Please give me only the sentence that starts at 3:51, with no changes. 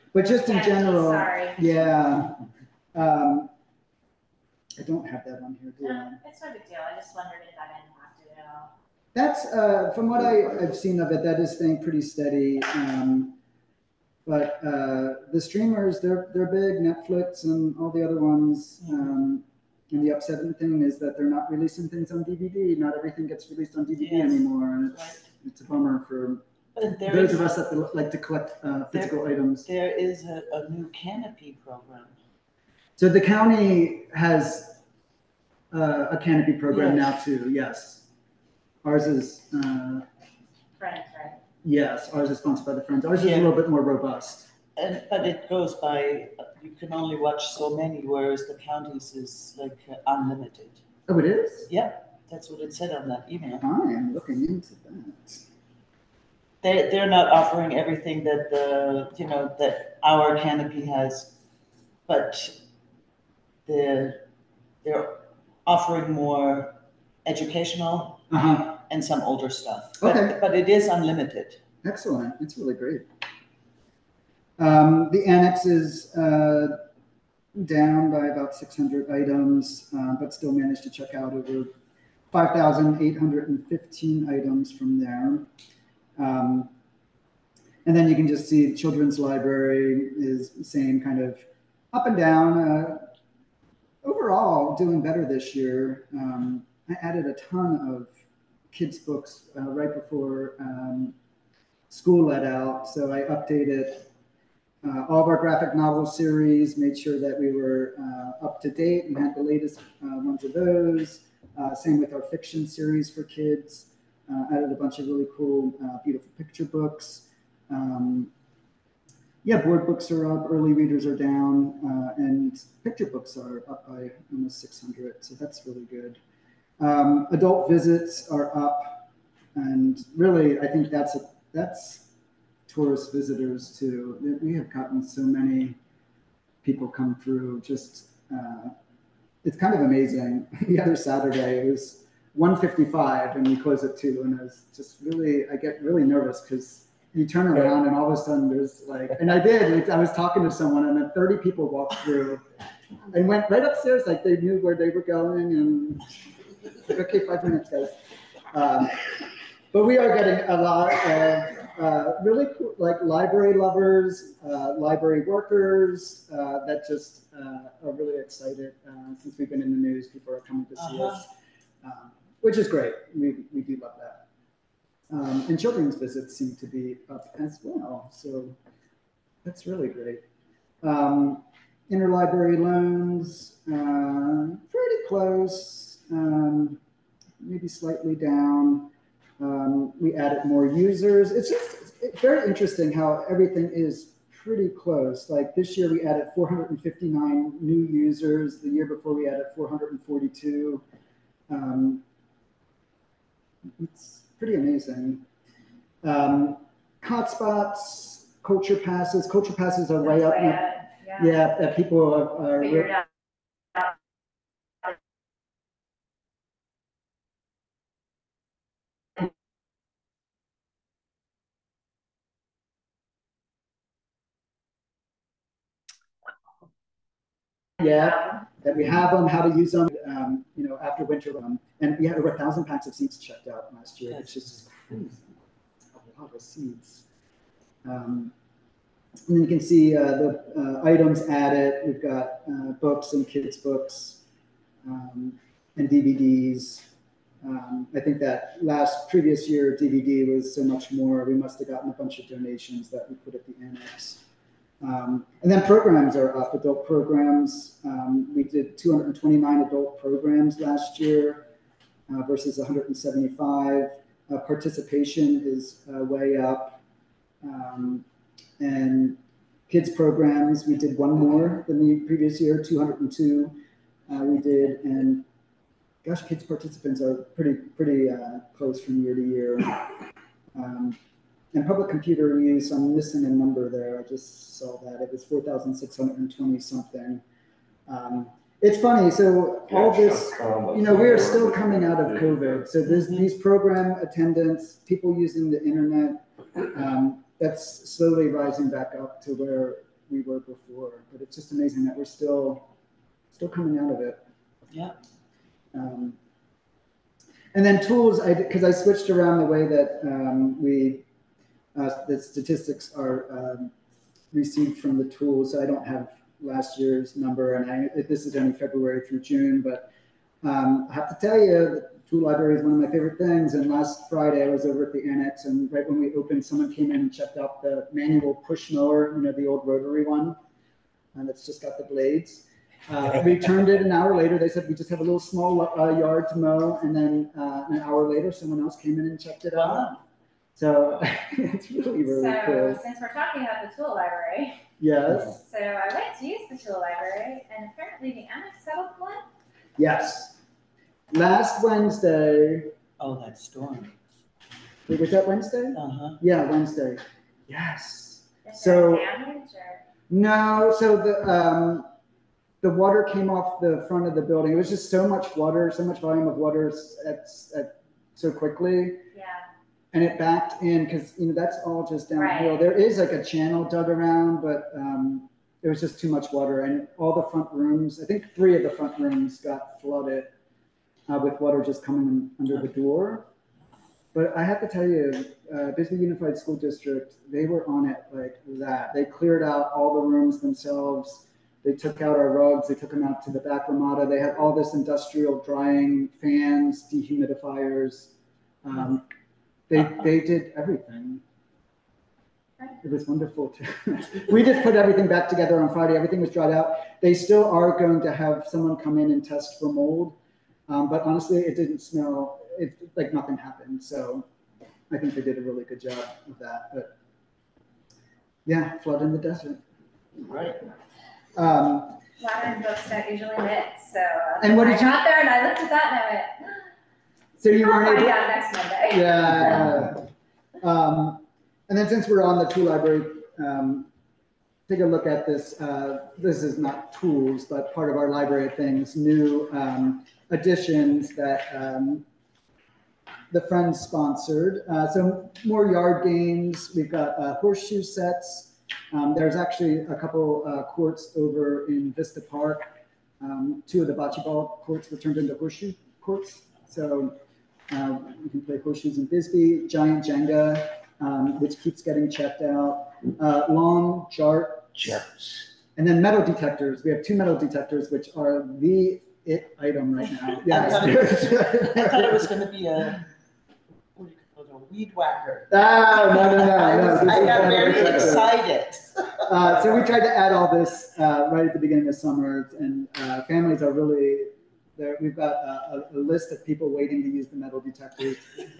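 Um, and we had over a thousand packs of seeds checked out last year, It's which is crazy.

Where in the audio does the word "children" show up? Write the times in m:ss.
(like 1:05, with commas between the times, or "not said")
1:28, 2:55.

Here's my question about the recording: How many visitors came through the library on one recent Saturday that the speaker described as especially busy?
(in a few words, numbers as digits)
155.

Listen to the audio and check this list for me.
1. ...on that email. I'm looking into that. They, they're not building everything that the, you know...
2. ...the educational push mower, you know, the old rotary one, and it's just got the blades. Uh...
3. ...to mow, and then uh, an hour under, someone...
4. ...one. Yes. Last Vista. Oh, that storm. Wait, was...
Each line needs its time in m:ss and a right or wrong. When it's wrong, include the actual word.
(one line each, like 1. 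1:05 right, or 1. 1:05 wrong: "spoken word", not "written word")
1. 0:52 wrong: "offering", not "building"
2. 5:27 wrong: "manual", not "educational"
3. 5:36 wrong: "later", not "under"
4. 5:48 wrong: "Wednesday", not "Vista".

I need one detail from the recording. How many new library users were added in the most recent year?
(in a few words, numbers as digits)
459.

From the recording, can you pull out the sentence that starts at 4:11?
We must have gotten a bunch of donations that we put at the annex.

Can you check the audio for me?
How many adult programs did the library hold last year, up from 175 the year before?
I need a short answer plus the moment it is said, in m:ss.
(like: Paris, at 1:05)
229, at 4:18.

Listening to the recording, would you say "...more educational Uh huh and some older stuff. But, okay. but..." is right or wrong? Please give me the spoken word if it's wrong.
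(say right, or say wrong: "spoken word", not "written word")
right.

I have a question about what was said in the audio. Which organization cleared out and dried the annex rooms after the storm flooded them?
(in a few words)
Bisbee Unified School District.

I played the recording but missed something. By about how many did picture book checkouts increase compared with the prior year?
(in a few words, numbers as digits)
600.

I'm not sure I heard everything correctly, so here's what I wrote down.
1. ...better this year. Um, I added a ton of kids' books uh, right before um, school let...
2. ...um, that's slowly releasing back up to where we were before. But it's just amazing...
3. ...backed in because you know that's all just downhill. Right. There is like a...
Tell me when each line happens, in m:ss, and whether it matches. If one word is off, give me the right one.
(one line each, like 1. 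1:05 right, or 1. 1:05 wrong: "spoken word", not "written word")
1. 1:35 right
2. 4:56 wrong: "rising", not "releasing"
3. 6:10 right.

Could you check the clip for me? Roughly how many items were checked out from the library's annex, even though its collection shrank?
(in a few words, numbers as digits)
5,815.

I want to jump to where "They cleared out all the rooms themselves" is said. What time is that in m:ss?
6:28.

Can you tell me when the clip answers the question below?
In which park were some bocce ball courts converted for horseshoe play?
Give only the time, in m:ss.
7:31.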